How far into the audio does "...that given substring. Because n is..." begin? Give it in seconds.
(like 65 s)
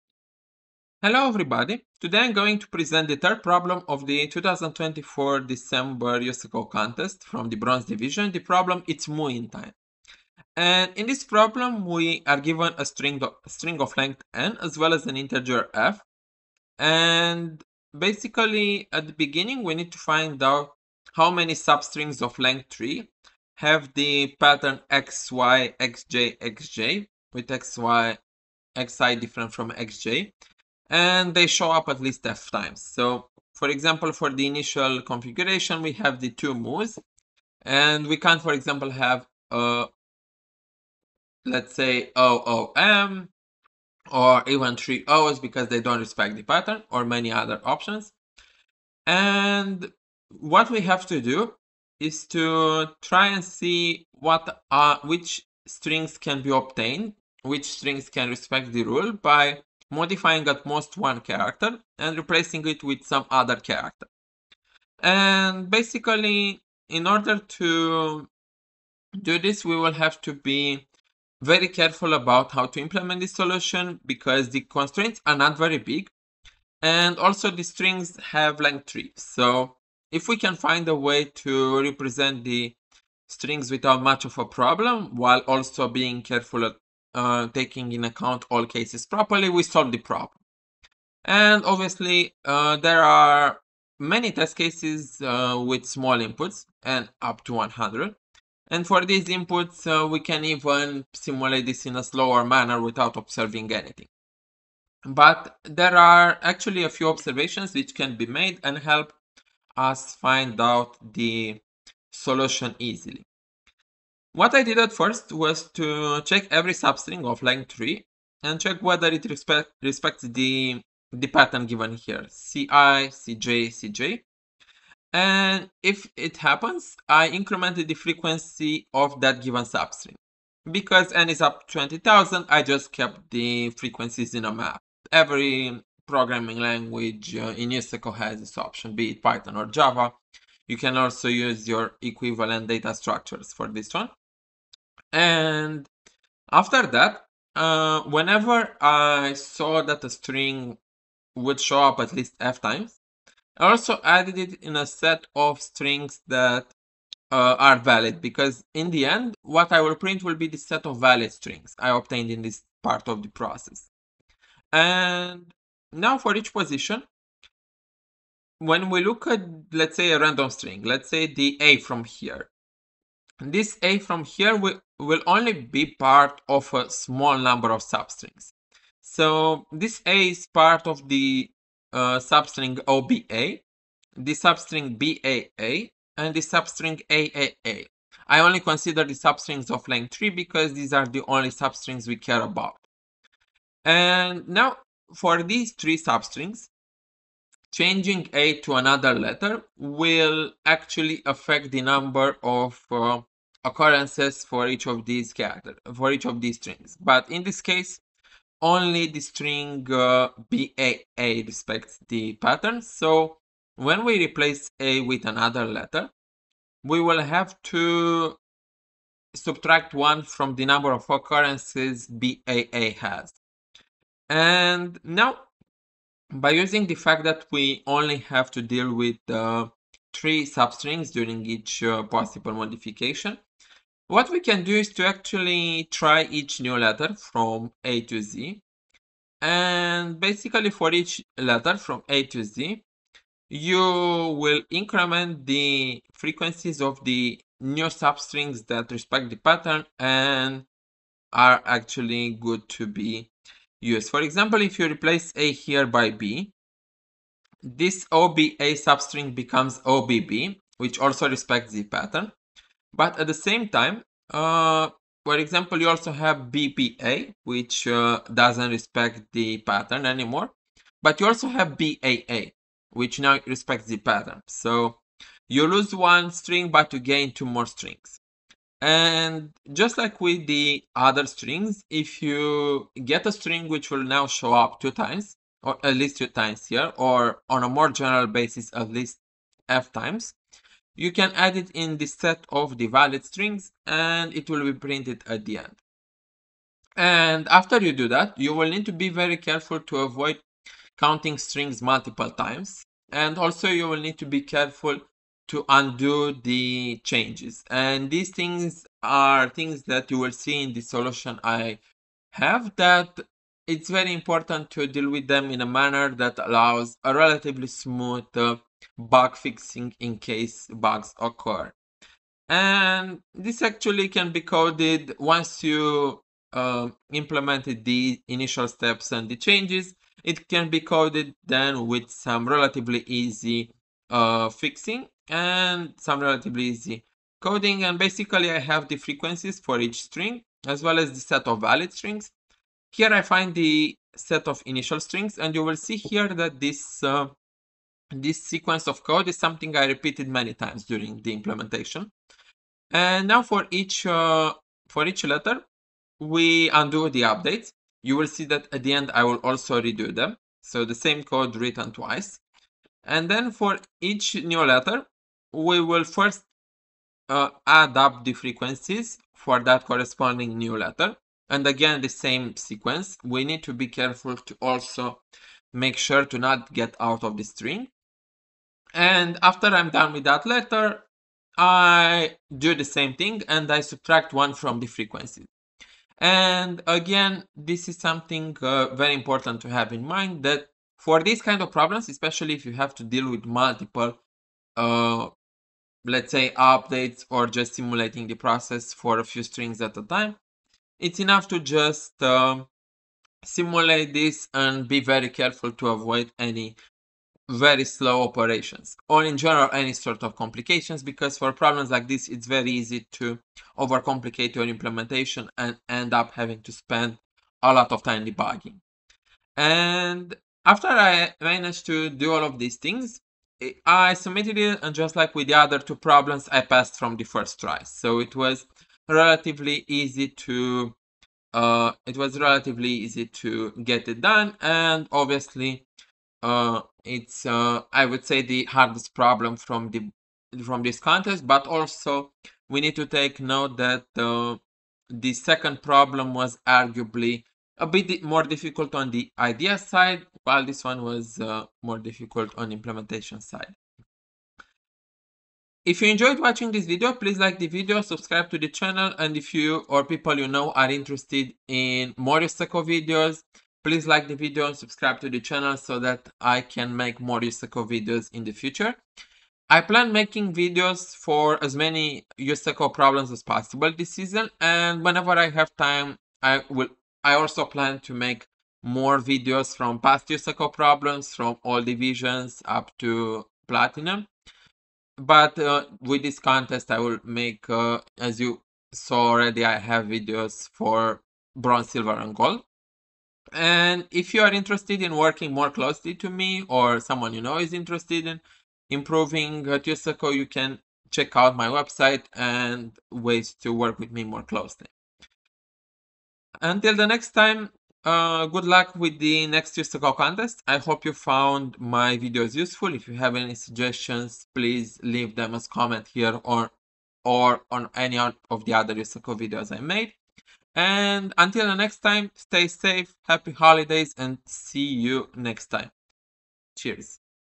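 129 s.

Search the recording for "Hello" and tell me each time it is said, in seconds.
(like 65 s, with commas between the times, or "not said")
1 s.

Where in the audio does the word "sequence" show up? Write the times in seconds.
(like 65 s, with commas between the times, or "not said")
348 s, 372 s.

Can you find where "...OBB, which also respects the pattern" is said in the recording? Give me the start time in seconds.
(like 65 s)
259 s.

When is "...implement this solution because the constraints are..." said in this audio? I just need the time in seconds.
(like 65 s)
72 s.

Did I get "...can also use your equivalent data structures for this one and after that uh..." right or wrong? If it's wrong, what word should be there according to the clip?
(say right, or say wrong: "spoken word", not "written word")
right.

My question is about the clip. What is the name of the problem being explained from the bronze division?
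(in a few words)
Mooin' Time.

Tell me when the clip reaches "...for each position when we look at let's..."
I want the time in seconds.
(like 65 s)
166 s.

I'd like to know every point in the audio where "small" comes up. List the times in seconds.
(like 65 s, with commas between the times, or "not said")
95 s, 176 s.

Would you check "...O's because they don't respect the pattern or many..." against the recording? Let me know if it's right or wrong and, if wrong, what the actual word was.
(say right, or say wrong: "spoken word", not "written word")
right.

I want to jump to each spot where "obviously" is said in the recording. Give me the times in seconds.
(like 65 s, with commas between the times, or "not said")
91 s, 435 s.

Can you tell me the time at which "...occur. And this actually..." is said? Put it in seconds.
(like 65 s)
321 s.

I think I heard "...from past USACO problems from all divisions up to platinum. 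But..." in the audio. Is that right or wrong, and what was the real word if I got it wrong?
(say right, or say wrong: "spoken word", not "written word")
right.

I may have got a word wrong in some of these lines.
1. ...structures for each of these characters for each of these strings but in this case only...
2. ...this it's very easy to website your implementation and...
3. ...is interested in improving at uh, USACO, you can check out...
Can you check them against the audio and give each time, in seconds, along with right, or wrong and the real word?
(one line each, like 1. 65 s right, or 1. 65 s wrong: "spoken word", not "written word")
1. 203 s wrong: "occurrences", not "structures"
2. 412 s wrong: "overcomplicate", not "website"
3. 497 s right.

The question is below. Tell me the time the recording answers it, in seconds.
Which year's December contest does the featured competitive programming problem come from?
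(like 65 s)
4 s.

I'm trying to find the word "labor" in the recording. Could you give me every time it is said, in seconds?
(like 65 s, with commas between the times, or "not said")
not said.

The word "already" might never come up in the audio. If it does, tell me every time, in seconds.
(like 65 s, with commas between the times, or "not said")
489 s.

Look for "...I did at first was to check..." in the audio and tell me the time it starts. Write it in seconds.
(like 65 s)
114 s.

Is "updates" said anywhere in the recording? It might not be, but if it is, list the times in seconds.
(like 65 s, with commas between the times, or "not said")
357 s, 396 s.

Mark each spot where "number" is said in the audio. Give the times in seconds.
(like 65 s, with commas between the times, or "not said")
177 s, 201 s, 220 s.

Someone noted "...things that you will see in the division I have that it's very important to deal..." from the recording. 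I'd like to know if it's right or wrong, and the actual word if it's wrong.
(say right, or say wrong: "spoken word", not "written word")
wrong: "solution", not "division".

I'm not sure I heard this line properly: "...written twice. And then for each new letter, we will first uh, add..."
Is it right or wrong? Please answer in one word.
right.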